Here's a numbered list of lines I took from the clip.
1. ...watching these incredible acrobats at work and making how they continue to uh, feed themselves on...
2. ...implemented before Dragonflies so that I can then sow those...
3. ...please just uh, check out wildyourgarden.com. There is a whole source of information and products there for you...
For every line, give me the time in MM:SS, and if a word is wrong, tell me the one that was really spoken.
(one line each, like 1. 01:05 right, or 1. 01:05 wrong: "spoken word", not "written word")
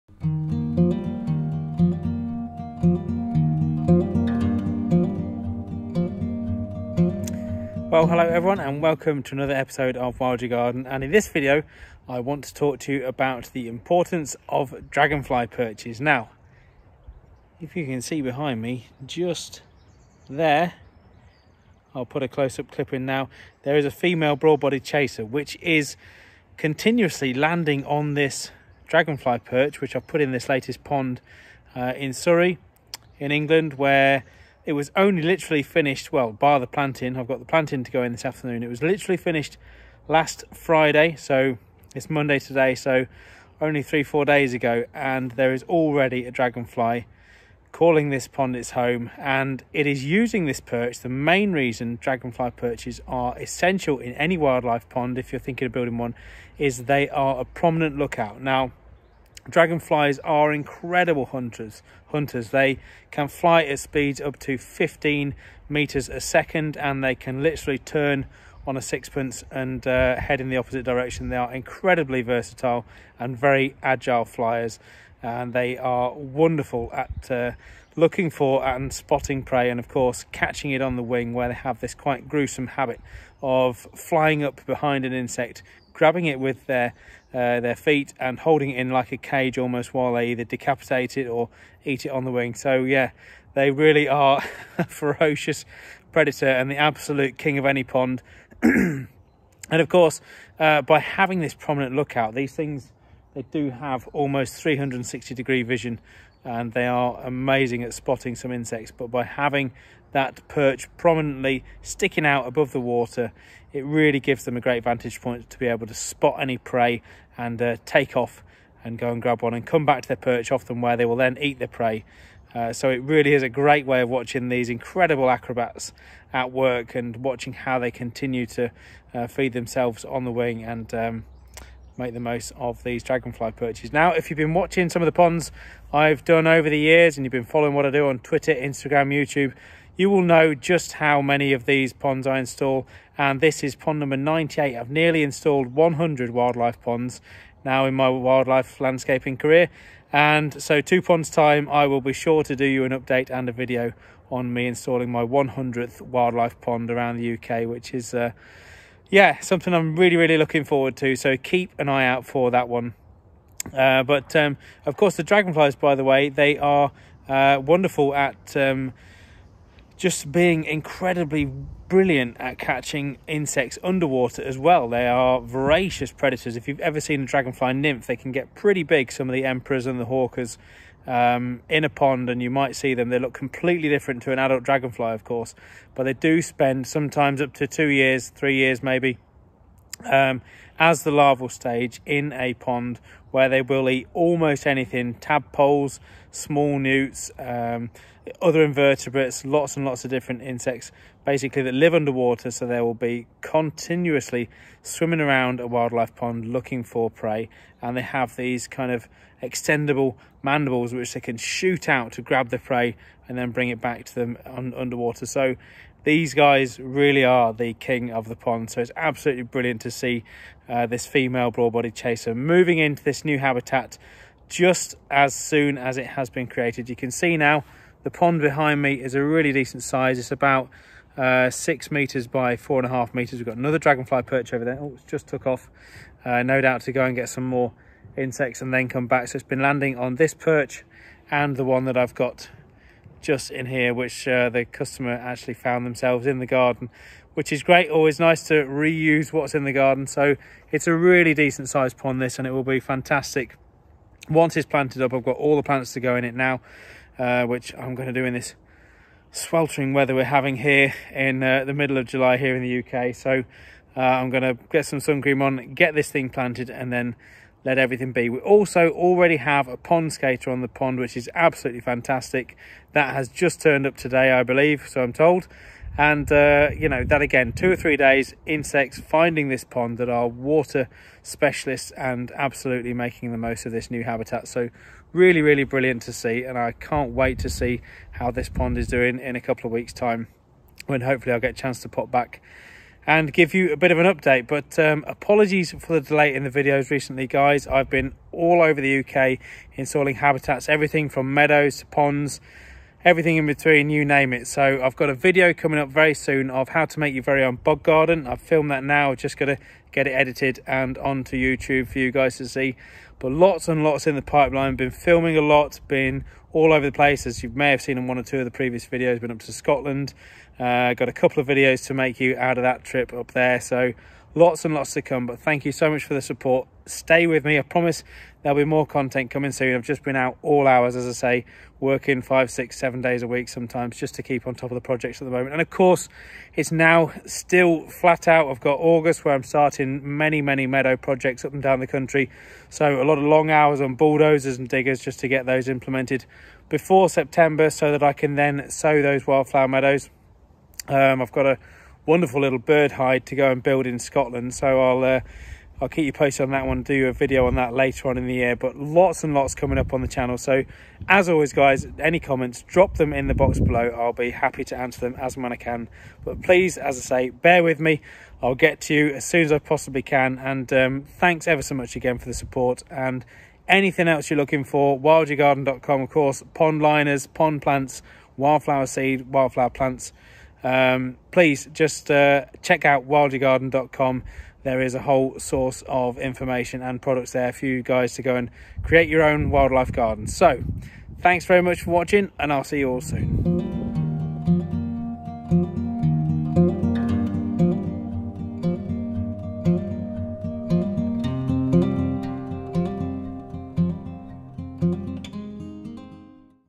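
1. 02:04 wrong: "watching", not "making"
2. 05:45 wrong: "September", not "Dragonflies"
3. 06:21 right.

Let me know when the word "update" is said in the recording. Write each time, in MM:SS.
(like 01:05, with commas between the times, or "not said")
02:32, 04:54.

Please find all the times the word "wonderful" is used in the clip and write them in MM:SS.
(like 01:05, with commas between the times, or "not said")
01:16, 02:47, 05:52.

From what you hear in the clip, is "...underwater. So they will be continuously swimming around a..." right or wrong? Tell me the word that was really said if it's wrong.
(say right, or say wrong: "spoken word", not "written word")
right.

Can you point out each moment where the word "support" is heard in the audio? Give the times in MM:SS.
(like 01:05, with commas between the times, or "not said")
05:26, 06:12.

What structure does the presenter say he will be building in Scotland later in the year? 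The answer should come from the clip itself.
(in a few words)
Bird hide.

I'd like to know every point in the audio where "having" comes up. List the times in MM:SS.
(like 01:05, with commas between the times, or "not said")
01:40, 01:49, 04:20.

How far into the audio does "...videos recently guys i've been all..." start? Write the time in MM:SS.
04:56.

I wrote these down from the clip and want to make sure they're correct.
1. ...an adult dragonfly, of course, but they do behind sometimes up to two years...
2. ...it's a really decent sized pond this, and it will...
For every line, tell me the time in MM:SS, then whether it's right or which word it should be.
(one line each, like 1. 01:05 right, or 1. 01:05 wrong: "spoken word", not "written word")
1. 03:04 wrong: "spend", not "behind"
2. 04:10 right.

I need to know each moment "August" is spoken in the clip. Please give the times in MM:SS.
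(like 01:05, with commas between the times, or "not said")
05:38.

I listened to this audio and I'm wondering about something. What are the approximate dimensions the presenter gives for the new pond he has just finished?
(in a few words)
6 by 4.5 meters.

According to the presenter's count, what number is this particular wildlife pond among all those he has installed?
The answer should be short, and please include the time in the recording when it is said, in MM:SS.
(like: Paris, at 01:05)
98, at 02:23.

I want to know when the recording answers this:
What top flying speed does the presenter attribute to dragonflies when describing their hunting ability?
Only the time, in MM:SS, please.
01:04.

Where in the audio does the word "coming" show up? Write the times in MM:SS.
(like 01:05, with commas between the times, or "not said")
05:05, 05:29, 05:59.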